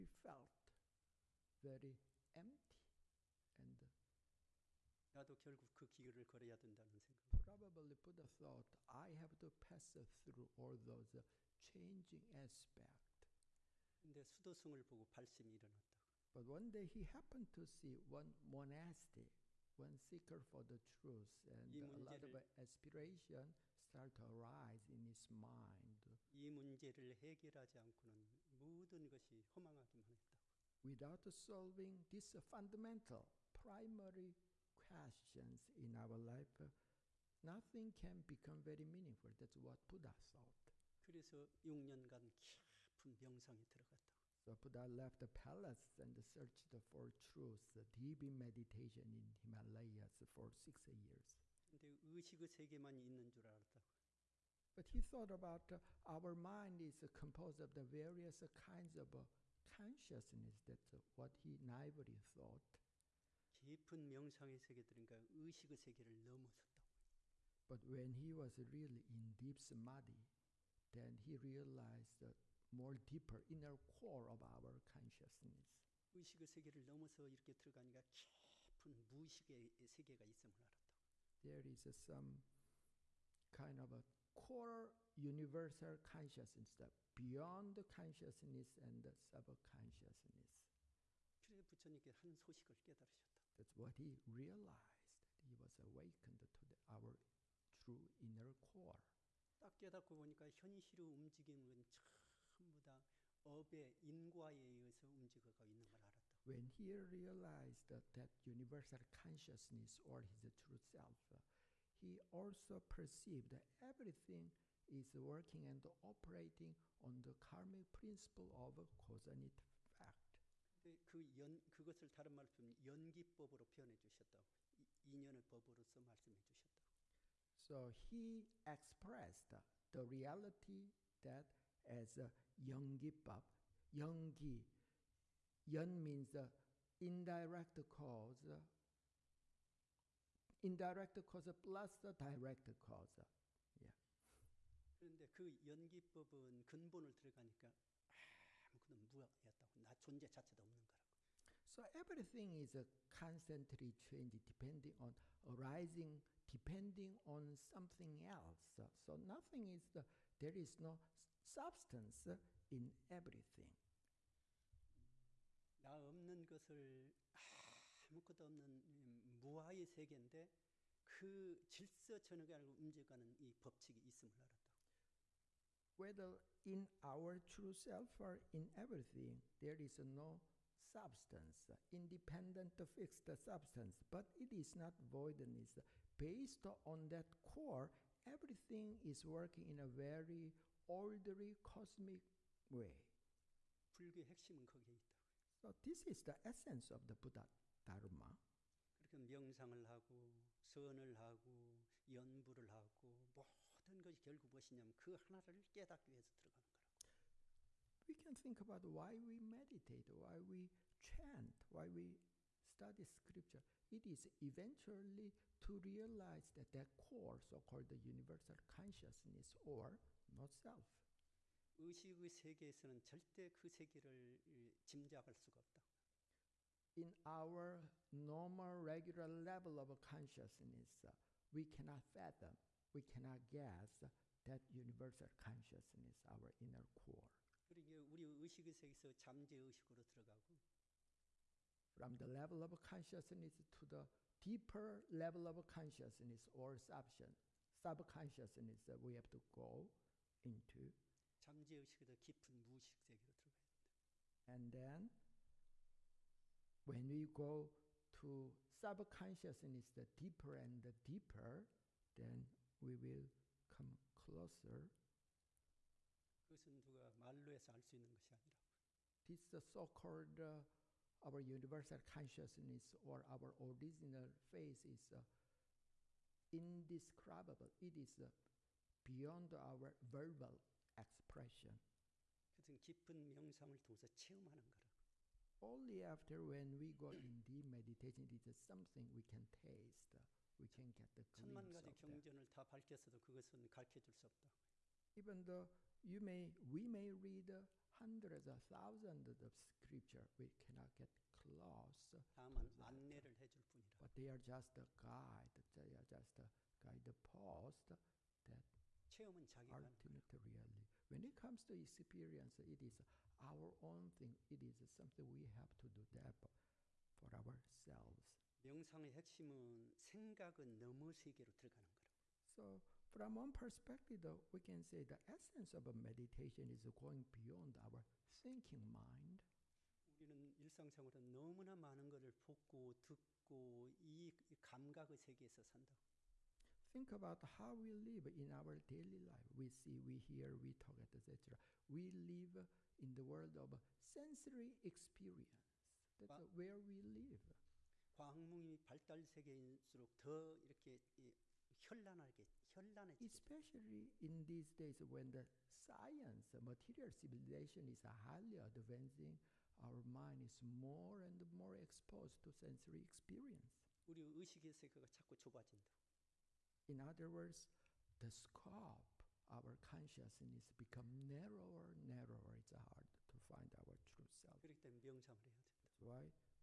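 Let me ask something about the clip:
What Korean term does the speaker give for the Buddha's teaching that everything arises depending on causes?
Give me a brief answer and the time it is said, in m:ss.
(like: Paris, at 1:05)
Yeongi-bap, at 2:12.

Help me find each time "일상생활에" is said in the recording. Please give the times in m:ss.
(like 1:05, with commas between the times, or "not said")
5:30.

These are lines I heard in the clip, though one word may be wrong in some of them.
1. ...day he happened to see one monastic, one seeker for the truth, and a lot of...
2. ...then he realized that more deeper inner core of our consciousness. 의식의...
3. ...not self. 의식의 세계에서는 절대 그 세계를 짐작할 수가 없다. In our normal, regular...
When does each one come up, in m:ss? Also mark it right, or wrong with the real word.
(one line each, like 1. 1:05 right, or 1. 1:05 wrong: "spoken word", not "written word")
1. 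0:16 right
2. 1:10 right
3. 3:40 right.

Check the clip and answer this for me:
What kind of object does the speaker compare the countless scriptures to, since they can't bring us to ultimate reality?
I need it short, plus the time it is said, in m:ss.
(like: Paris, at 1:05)
guide post, at 5:06.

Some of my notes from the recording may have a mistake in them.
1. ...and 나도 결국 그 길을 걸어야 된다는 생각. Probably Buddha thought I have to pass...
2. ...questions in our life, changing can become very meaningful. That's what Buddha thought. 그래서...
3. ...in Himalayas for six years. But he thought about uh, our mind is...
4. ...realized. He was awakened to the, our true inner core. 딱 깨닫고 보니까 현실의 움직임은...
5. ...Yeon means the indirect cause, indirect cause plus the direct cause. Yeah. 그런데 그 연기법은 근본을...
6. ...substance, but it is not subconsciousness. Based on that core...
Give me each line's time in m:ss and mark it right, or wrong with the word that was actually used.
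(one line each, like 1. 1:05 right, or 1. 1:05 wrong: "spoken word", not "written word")
1. 0:03 right
2. 0:34 wrong: "nothing", not "changing"
3. 0:49 right
4. 1:34 right
5. 2:15 right
6. 3:03 wrong: "voidness", not "subconsciousness".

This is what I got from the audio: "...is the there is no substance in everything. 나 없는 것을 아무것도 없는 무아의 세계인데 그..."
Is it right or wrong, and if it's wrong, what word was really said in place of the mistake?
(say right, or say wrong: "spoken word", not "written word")
right.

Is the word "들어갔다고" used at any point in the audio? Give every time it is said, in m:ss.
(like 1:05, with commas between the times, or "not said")
0:43.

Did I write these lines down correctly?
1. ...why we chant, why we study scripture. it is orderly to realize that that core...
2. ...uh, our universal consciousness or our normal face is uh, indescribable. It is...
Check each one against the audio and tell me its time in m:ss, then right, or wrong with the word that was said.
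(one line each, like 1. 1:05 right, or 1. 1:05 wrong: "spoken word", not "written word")
1. 3:30 wrong: "eventually", not "orderly"
2. 4:30 wrong: "original", not "normal".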